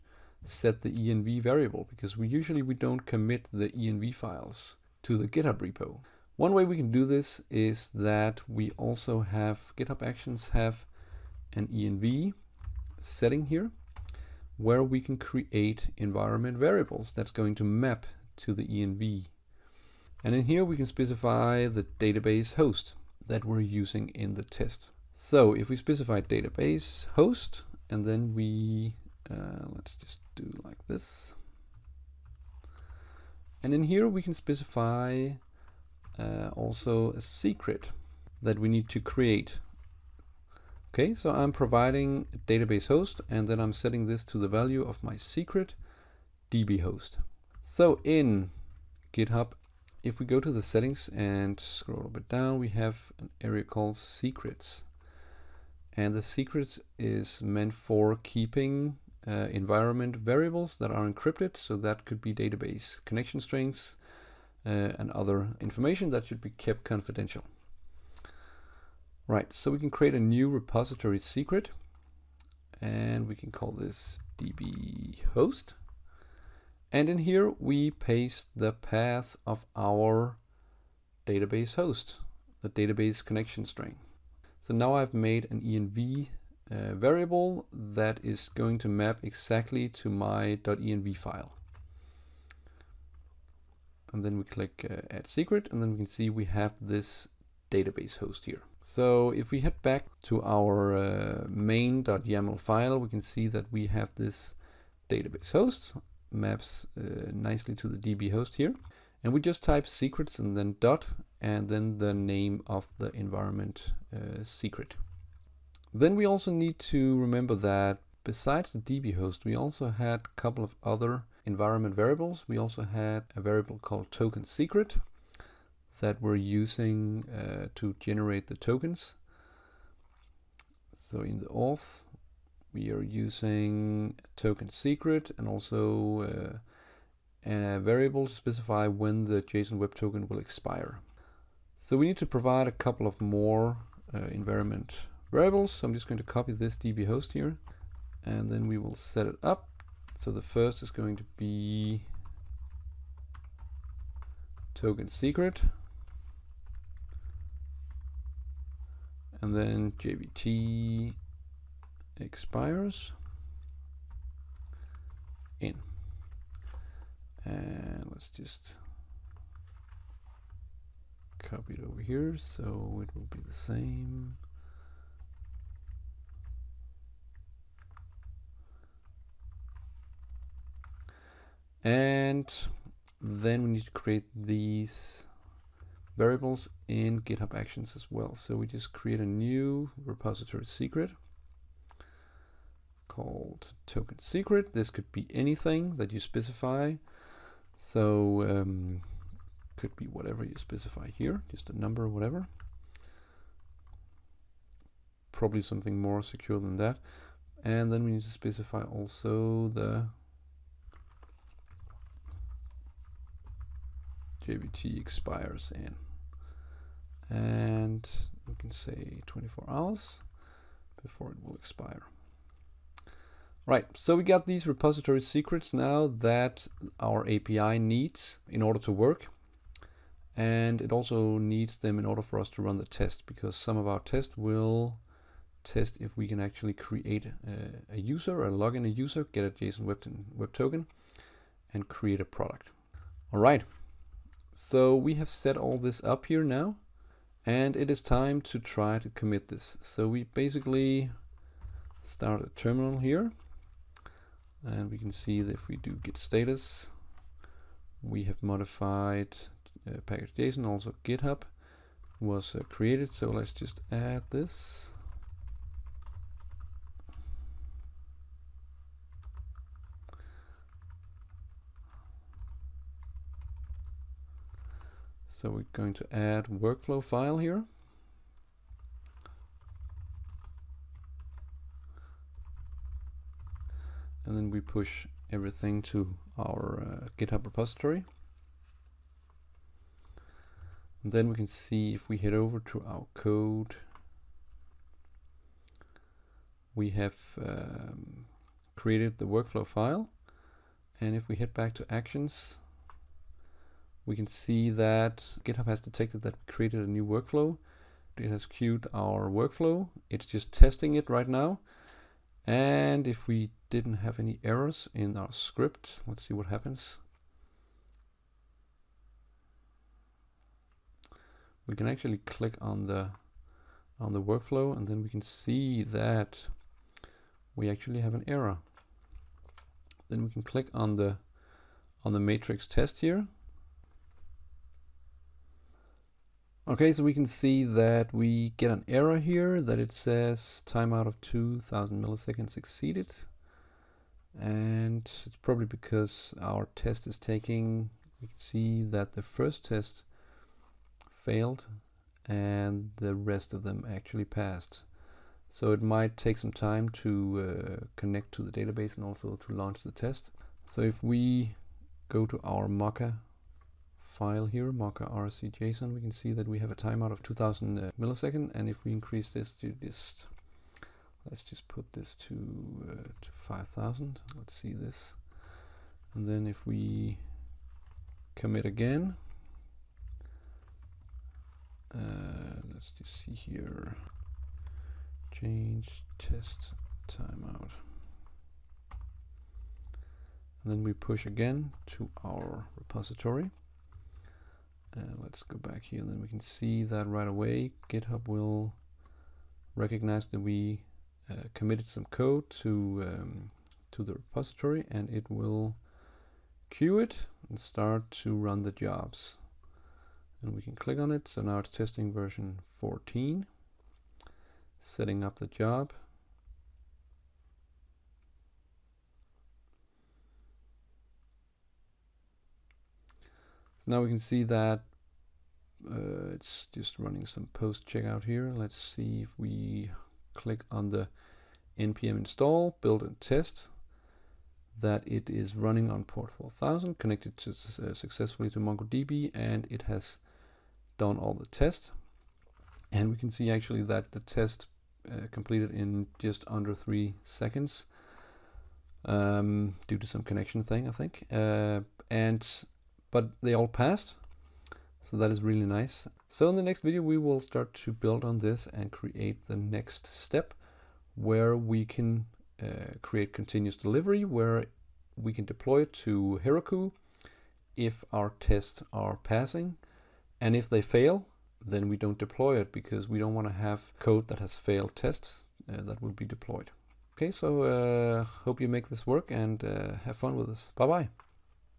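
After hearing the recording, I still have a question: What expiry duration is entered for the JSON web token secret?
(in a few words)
24 hours.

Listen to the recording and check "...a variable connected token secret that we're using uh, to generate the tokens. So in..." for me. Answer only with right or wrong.
wrong.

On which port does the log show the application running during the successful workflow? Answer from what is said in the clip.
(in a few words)
4000.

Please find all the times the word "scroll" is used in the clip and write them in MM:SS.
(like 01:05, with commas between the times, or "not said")
00:51.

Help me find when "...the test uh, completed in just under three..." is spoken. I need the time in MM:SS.
07:24.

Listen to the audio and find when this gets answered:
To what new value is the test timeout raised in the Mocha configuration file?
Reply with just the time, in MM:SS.
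06:13.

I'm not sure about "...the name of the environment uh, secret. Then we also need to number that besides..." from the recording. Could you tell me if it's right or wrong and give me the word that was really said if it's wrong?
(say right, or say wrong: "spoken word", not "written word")
wrong: "remember", not "number".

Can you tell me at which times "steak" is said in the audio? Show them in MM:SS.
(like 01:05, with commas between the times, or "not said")
not said.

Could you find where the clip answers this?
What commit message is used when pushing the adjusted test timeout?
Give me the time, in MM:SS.
06:25.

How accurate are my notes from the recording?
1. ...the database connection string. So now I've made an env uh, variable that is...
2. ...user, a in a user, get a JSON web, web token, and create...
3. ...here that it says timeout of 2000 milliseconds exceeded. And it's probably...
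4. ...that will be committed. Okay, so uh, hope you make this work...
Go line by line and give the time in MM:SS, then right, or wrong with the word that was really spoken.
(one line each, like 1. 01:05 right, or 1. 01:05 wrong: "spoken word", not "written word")
1. 01:22 right
2. 03:57 right
3. 05:39 right
4. 07:55 wrong: "deployed", not "committed".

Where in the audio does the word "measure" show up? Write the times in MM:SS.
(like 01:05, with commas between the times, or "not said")
not said.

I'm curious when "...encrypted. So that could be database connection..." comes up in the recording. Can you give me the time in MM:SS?
01:01.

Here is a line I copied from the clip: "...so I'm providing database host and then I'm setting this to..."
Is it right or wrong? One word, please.
right.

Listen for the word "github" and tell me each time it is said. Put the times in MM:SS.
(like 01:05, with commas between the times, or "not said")
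00:05, 00:09, 00:49, 03:07, 04:21, 04:47, 05:05, 06:37.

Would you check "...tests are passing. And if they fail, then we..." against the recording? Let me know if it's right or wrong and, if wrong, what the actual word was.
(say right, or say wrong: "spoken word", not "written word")
right.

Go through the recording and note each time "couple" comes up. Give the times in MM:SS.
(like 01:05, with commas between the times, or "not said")
02:00, 02:22.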